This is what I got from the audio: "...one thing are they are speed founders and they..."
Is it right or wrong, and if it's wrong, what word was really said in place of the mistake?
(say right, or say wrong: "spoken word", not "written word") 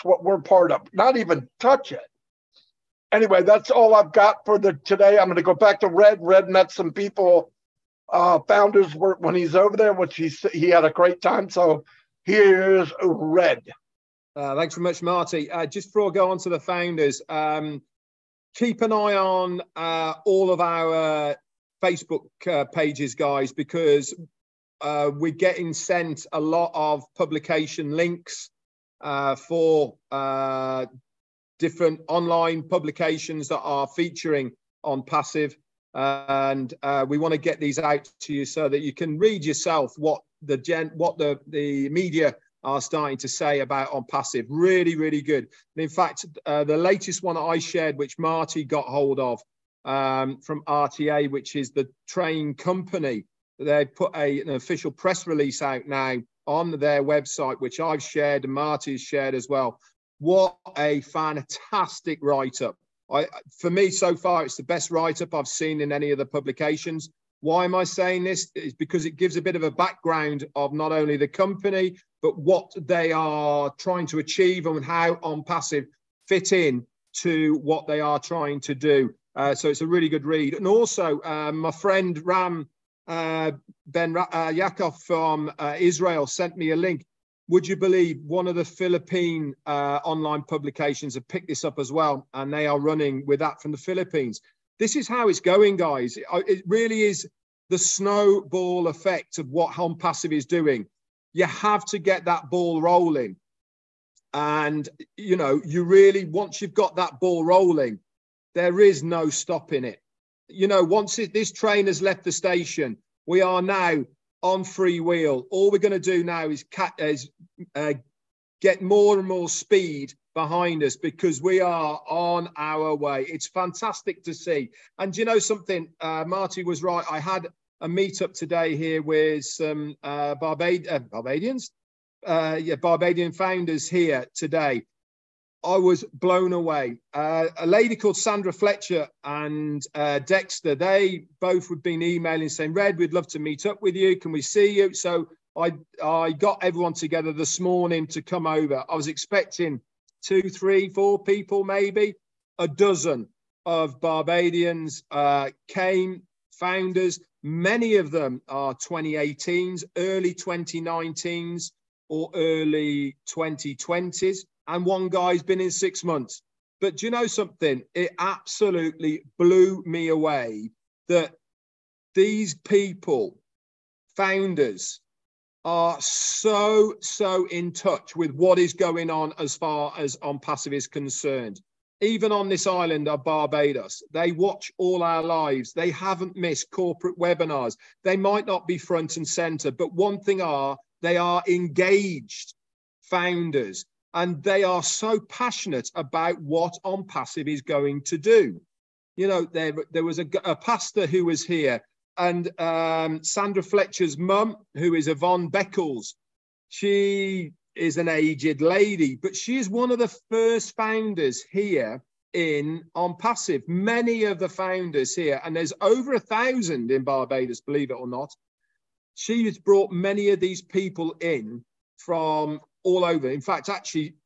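wrong: "engaged", not "speed".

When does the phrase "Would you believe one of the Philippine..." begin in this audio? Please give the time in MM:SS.
01:27.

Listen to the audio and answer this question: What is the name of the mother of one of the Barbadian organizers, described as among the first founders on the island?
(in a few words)
Yvonne Beckles.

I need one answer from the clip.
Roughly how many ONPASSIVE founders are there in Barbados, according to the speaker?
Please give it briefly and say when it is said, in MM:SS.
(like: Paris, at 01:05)
over 1,000, at 03:35.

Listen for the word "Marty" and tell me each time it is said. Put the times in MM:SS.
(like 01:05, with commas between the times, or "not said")
00:15, 00:48, 00:58, 02:06.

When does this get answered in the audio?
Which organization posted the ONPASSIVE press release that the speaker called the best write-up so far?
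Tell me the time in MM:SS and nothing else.
00:50.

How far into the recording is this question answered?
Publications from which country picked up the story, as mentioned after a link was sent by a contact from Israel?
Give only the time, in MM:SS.
01:33.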